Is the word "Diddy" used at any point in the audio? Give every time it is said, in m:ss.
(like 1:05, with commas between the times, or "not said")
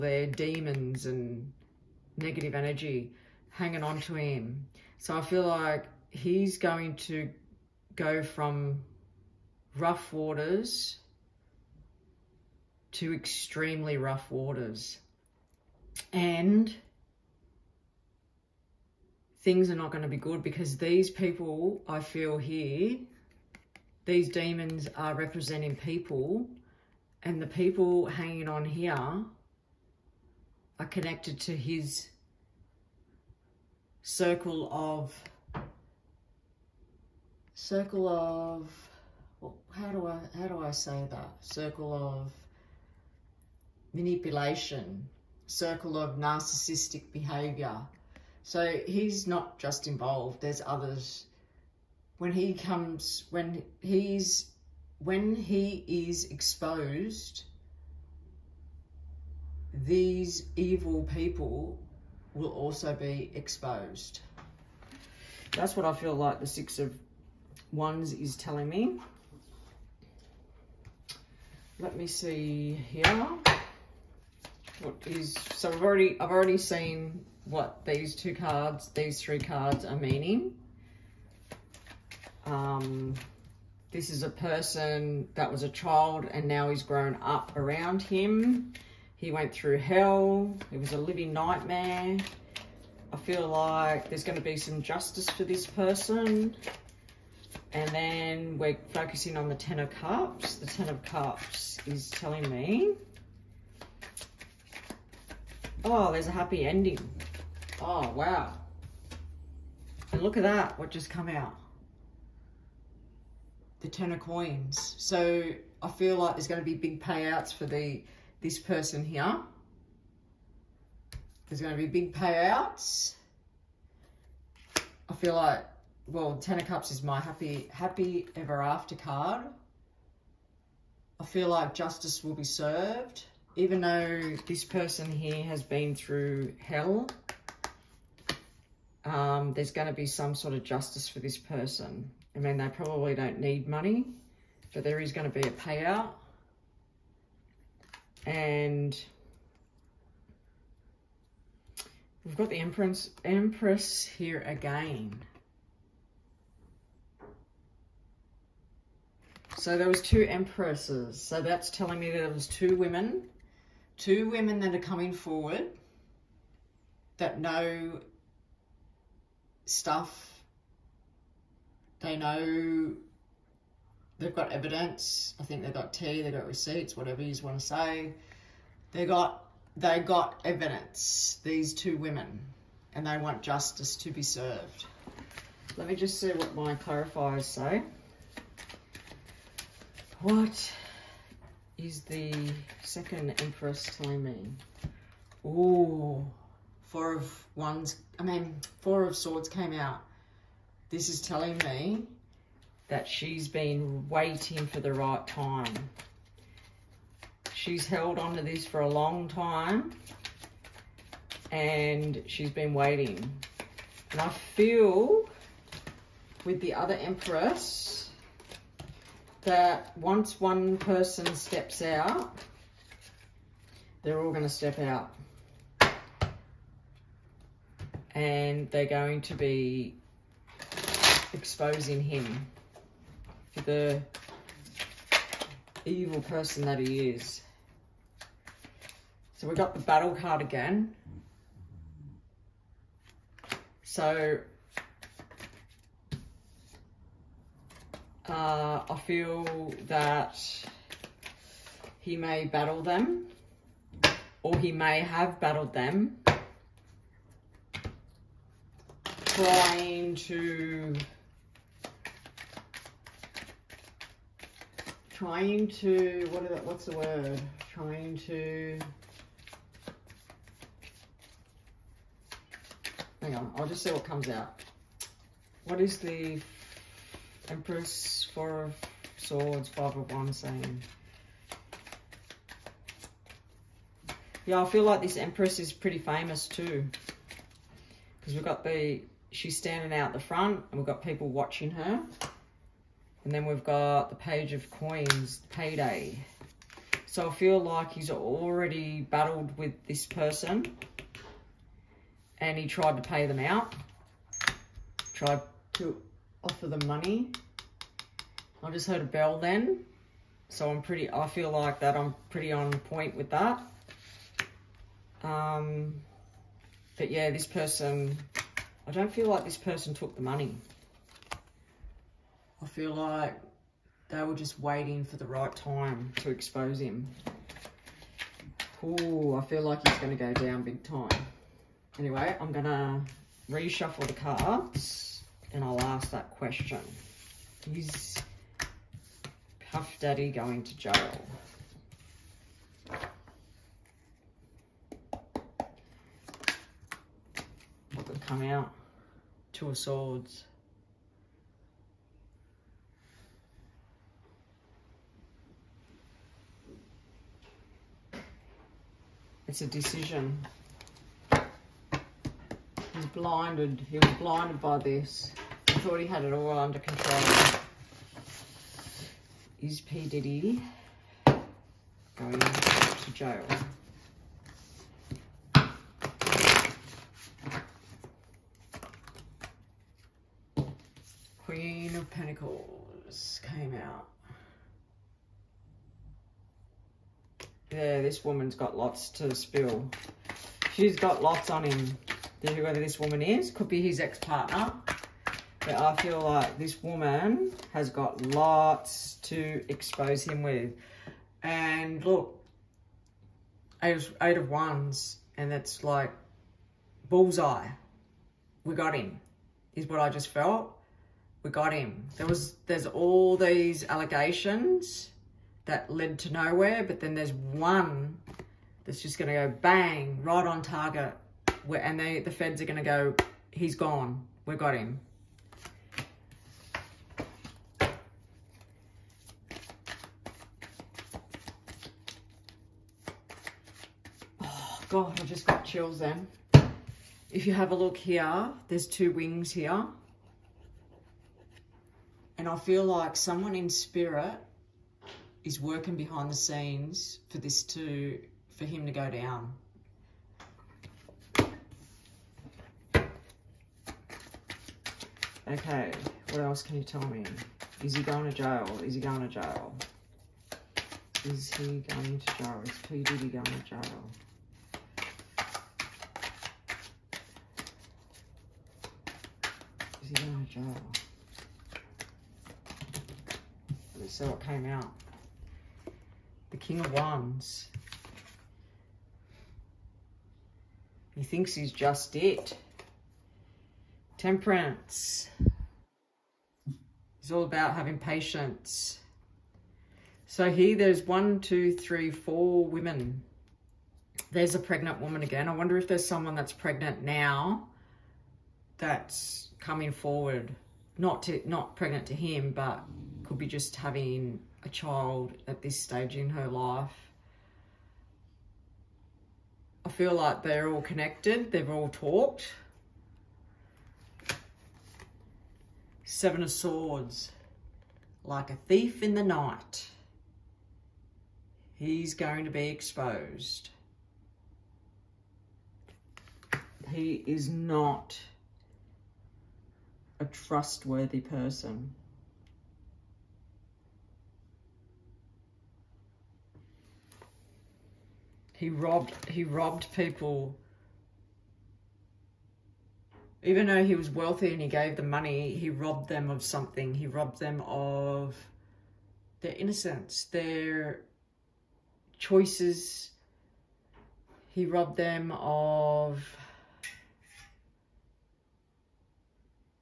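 6:10, 7:43.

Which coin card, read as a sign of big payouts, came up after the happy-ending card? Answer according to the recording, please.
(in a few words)
10 of coins.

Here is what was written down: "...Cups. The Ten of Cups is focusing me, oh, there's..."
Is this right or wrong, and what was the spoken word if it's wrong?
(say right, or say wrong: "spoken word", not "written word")
wrong: "telling", not "focusing".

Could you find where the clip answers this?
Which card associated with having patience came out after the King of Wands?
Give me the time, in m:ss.
8:04.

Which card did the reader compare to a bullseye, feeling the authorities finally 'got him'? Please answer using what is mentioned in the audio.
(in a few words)
Eight of Wands.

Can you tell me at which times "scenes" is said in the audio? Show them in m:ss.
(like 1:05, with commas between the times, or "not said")
7:26.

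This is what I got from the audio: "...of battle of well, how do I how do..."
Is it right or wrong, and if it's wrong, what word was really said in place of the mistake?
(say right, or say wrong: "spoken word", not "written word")
wrong: "circle", not "battle".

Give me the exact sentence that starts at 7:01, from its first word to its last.
and they, the feds are going to go, he's gone.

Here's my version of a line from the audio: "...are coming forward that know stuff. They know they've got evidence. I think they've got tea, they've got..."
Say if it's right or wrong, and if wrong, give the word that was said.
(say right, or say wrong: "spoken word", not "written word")
right.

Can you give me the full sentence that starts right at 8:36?
Seven of Swords, like a thief in the night.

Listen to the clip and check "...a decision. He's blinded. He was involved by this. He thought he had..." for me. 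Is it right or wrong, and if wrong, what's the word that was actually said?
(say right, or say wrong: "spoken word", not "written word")
wrong: "blinded", not "involved".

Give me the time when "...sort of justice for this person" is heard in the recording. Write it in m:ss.
2:20.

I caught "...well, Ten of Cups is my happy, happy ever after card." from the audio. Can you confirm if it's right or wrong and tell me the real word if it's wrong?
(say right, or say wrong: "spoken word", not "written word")
right.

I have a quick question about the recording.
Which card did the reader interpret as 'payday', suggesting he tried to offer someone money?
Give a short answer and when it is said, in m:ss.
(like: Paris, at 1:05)
Page of Coins, at 4:54.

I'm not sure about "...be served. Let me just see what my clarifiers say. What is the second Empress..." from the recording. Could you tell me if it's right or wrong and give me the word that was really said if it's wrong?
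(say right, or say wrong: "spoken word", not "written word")
right.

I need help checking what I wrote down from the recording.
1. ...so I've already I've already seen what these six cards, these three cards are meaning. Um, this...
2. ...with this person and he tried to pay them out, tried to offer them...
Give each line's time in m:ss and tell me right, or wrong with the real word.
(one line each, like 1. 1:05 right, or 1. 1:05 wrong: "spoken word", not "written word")
1. 1:15 wrong: "two", not "six"
2. 4:59 right.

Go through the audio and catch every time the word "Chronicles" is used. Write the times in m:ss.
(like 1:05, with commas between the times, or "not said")
6:22.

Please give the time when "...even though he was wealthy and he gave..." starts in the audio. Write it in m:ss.
9:03.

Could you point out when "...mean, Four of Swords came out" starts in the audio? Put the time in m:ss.
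3:18.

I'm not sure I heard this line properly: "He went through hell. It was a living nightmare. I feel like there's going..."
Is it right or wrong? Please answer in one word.
right.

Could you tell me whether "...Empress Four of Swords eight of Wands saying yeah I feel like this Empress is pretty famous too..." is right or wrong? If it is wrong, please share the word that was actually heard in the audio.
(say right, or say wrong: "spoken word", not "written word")
wrong: "five", not "eight".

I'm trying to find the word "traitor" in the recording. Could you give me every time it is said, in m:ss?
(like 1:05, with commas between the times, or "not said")
not said.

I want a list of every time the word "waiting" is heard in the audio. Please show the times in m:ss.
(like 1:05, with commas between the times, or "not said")
3:24, 3:32, 5:24.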